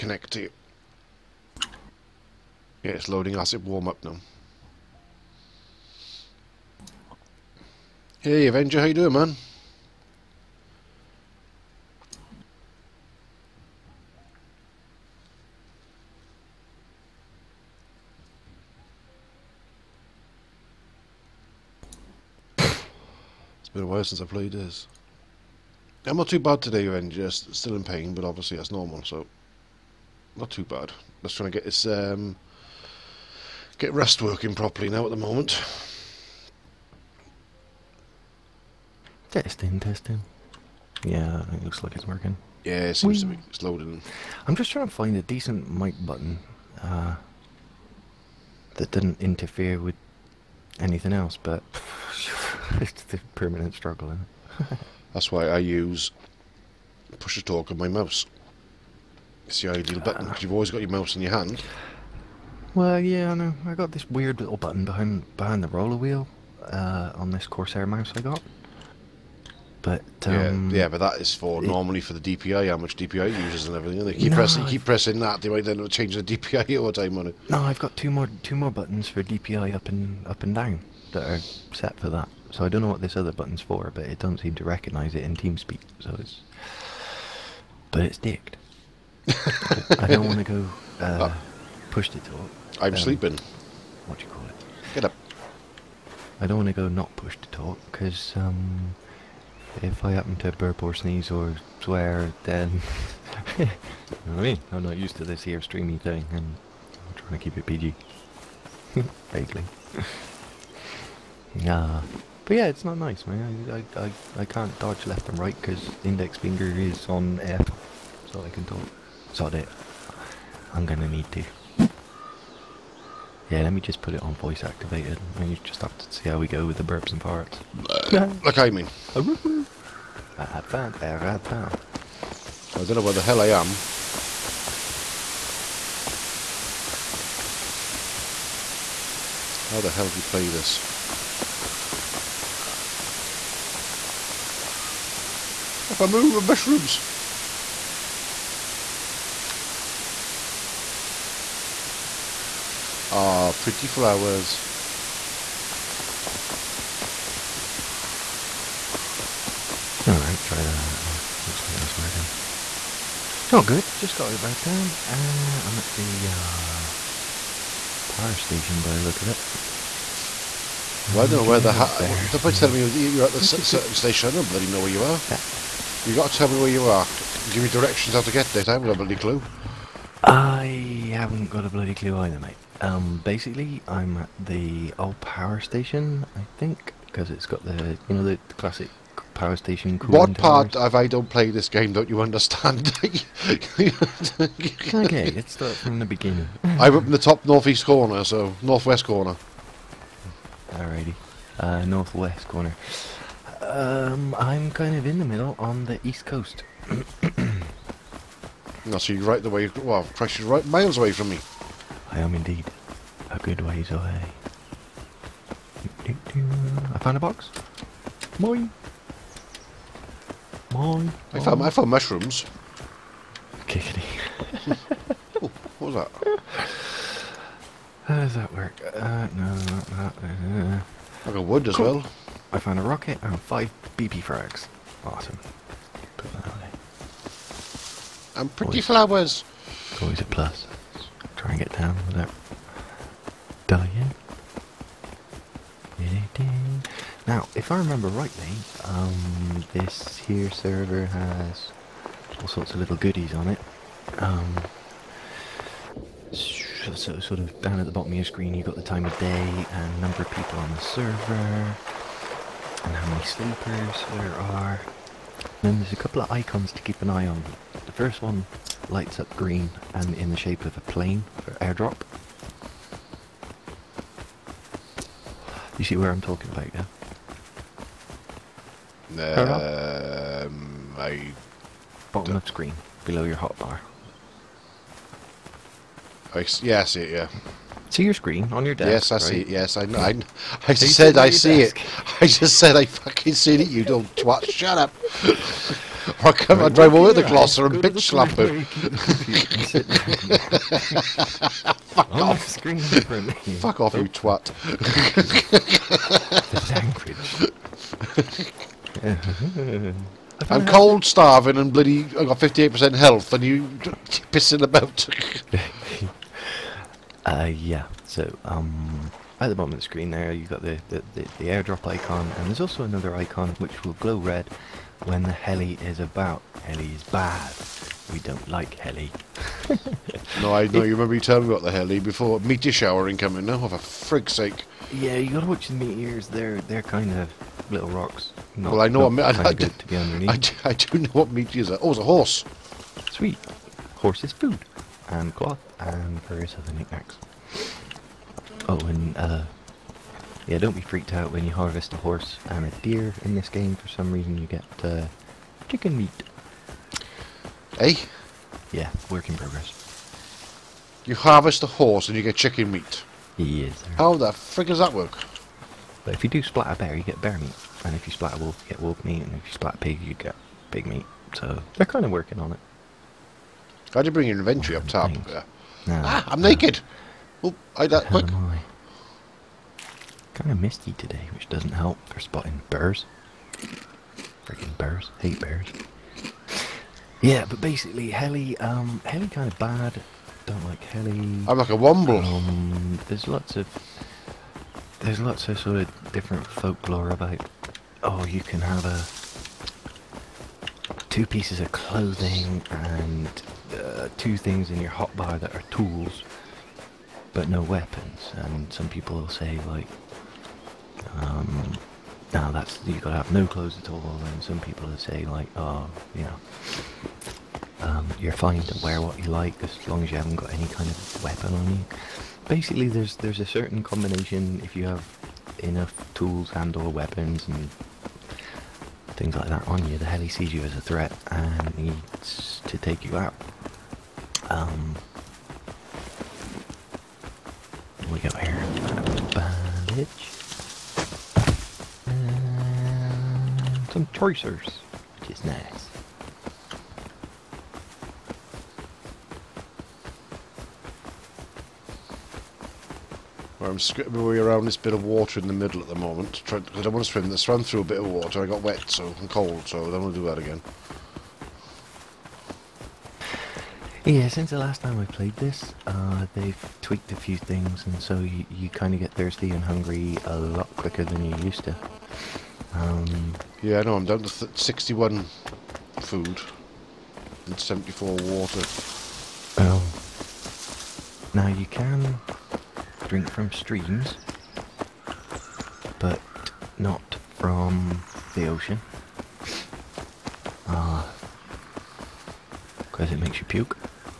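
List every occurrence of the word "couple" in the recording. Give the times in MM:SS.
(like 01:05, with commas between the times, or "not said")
04:25.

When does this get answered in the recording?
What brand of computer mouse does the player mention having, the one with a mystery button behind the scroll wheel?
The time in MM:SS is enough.
01:07.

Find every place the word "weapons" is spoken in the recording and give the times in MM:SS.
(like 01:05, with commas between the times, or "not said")
06:47, 07:01, 07:06.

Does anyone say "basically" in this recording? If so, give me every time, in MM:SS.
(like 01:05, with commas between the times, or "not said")
03:03, 06:27, 07:02.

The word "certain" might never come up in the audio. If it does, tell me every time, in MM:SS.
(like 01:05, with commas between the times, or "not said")
02:53, 07:03.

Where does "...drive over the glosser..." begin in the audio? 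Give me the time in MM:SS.
04:56.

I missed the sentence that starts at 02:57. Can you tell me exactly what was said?
Give me directions how to get there.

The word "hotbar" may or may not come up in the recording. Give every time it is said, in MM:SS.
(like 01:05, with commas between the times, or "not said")
04:43, 06:44.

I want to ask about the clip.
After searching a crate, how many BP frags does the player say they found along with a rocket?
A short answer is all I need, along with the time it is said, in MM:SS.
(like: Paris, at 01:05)
5, at 03:53.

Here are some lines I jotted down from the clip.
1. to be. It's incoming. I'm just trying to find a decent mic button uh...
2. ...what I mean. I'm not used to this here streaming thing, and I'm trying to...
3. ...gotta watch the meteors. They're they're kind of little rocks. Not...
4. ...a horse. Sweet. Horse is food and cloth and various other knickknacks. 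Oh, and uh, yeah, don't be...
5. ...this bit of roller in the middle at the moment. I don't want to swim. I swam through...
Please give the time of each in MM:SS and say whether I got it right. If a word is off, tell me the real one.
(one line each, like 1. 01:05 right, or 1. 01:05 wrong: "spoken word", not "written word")
1. 00:43 wrong: "loading", not "incoming"
2. 01:44 right
3. 05:35 right
4. 05:42 right
5. 07:34 wrong: "water", not "roller".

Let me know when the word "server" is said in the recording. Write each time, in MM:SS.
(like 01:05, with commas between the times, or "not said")
04:10, 04:20.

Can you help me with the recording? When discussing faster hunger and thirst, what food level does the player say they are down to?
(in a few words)
61.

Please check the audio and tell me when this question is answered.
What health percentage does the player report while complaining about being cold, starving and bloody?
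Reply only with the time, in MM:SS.
05:12.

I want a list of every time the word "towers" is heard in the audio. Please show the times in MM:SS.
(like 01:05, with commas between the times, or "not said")
03:10.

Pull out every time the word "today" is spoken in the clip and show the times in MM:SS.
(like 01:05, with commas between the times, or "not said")
00:26, 06:20.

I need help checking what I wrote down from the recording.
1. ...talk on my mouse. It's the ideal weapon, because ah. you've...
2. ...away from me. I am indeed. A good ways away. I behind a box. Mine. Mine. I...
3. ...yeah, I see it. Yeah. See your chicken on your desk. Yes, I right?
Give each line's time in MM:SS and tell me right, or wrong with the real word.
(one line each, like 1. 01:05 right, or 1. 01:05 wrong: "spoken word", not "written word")
1. 00:57 wrong: "button", not "weapon"
2. 03:30 wrong: "found", not "behind"
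3. 04:46 wrong: "screen", not "chicken".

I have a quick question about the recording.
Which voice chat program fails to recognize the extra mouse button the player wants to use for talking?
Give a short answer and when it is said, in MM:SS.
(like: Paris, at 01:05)
TeamSpeak, at 01:25.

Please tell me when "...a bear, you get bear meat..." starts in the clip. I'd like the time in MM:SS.
06:06.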